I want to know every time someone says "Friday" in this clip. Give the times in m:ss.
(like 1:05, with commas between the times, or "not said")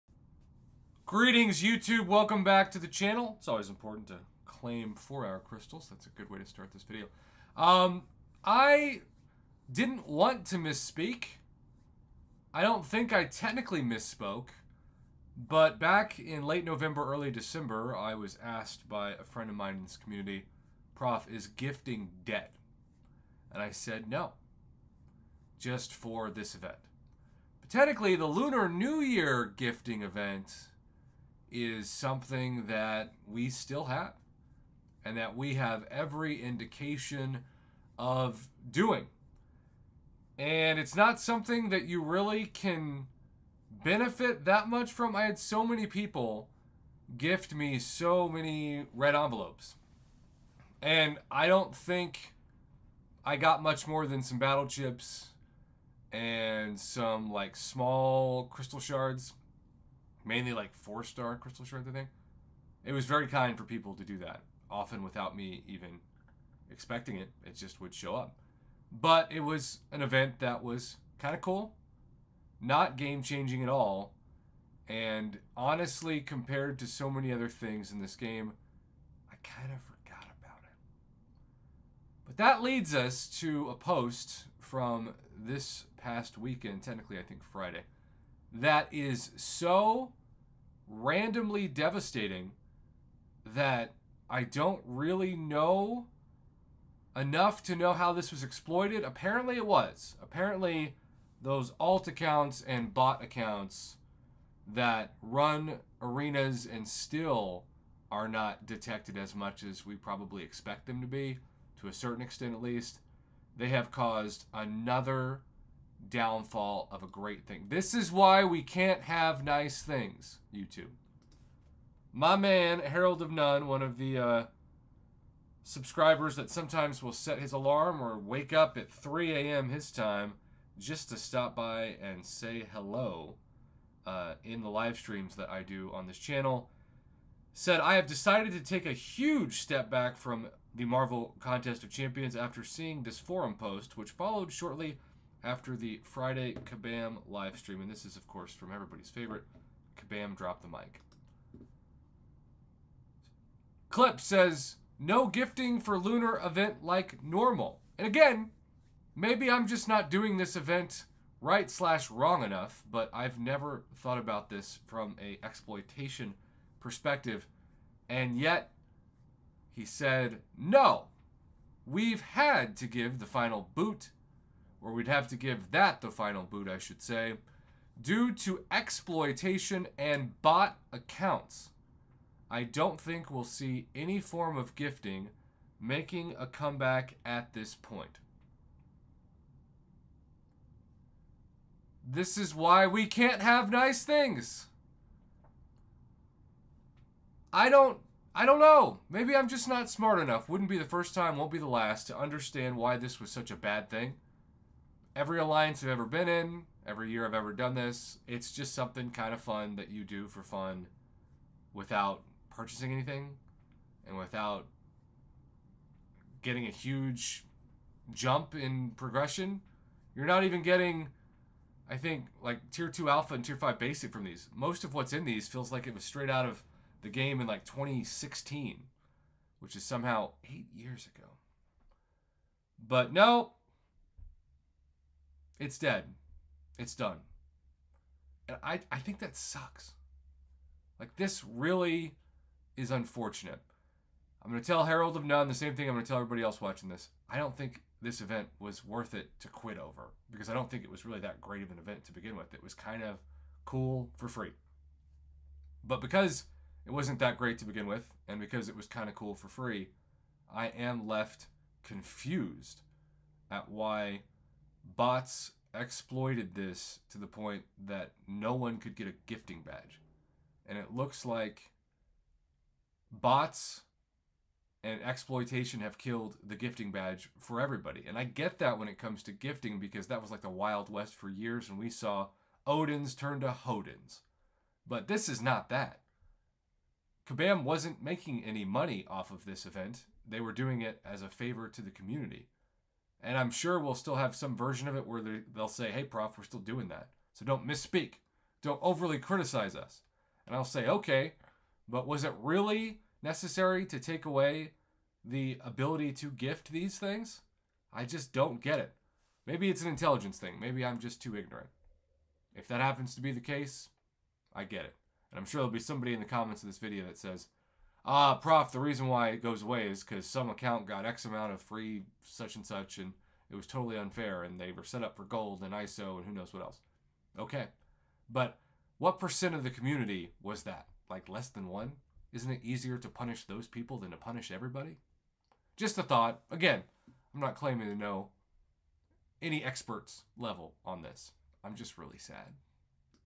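1:27, 2:26.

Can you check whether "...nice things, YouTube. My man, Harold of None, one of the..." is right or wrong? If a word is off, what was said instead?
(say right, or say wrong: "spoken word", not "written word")
right.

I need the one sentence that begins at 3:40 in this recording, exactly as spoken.
You're not even getting, I think, like tier 2 alpha and tier 5 basic from these.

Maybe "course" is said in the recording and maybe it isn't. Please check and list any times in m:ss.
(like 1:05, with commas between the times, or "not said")
2:28.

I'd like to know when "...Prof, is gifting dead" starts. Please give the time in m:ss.
0:20.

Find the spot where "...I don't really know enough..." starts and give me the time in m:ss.
1:34.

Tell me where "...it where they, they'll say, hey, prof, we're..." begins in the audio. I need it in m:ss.
4:54.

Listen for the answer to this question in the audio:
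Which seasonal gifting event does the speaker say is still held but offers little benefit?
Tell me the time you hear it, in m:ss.
0:28.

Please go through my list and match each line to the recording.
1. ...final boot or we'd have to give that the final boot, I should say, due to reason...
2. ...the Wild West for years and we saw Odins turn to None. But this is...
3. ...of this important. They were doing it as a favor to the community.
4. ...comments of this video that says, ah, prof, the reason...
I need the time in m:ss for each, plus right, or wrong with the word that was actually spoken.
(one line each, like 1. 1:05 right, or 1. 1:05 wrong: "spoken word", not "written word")
1. 2:53 wrong: "exploitation", not "reason"
2. 4:40 wrong: "Hodins", not "None"
3. 4:49 wrong: "event", not "important"
4. 5:16 right.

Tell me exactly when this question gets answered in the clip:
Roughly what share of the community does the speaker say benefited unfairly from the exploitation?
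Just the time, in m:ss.
5:31.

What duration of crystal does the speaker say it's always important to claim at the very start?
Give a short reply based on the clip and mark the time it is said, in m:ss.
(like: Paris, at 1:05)
4-hour crystals, at 0:04.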